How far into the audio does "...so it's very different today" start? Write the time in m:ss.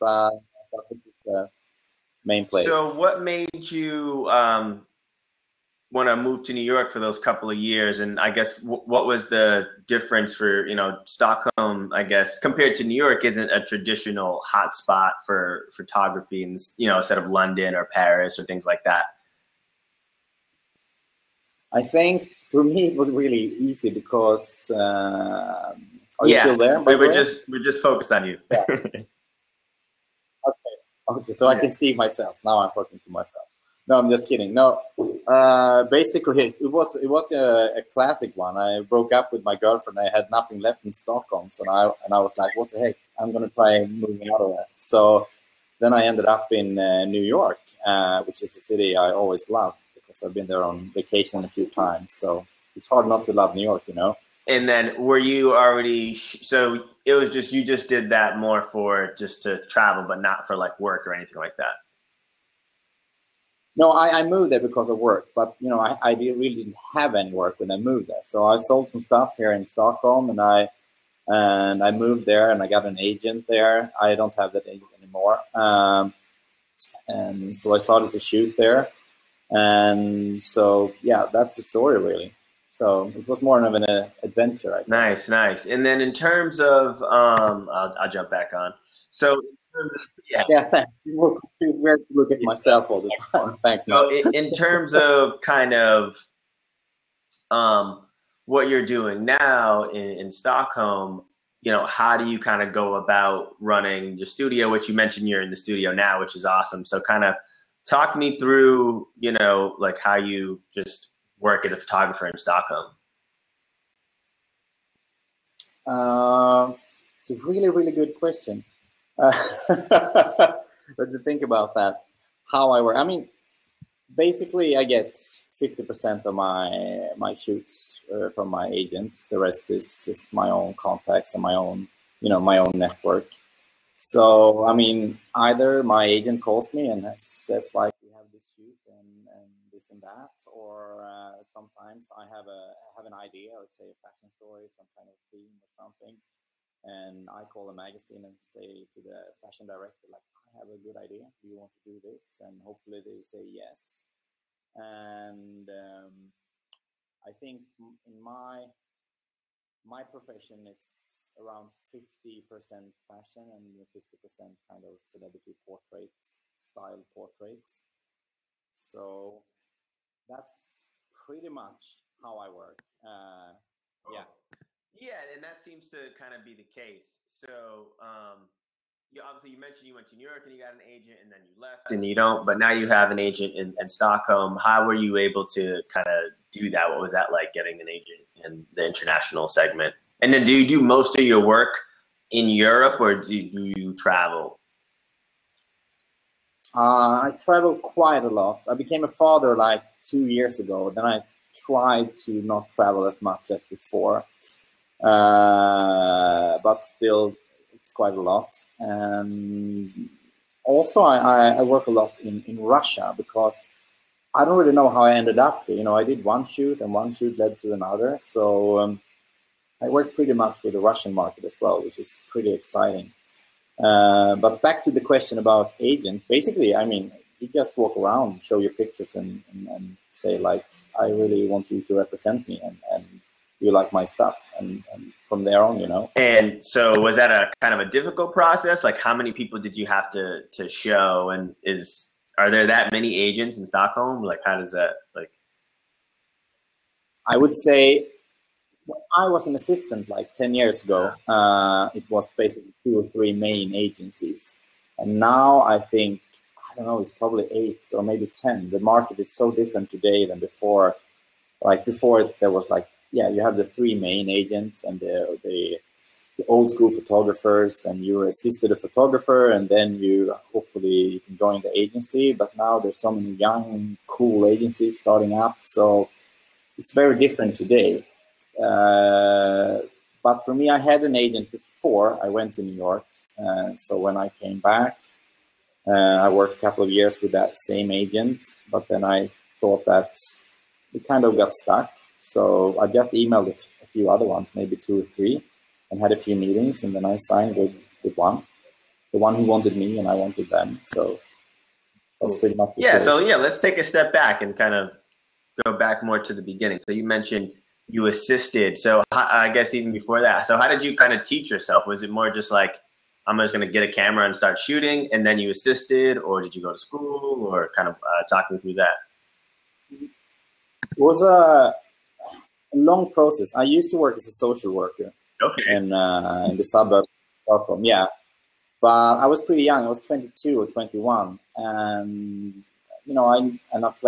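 4:35.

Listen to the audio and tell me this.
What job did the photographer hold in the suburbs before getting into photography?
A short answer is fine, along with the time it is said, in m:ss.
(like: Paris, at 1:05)
Social worker, at 5:24.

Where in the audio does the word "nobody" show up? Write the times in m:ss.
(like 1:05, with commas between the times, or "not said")
not said.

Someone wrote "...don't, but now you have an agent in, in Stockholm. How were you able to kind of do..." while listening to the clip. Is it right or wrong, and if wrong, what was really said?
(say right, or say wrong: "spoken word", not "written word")
right.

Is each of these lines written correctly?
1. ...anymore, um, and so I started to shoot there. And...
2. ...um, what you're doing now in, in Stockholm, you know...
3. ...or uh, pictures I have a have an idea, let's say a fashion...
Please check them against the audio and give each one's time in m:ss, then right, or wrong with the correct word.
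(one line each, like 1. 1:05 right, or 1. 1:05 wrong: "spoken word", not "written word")
1. 1:15 right
2. 1:37 right
3. 2:20 wrong: "sometimes", not "pictures".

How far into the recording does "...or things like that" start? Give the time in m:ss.
0:18.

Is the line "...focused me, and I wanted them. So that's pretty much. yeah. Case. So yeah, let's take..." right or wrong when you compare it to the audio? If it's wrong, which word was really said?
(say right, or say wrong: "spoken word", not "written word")
wrong: "wanted", not "focused".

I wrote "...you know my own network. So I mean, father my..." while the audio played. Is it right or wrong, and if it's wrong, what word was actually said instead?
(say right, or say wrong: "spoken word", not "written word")
wrong: "either", not "father".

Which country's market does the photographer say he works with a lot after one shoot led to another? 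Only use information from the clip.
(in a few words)
Russia.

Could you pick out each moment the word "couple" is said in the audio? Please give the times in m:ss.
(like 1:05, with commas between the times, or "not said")
0:07, 4:46.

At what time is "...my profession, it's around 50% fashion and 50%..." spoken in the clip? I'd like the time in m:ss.
2:39.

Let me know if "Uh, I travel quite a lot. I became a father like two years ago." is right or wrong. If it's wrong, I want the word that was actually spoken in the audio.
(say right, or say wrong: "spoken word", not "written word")
right.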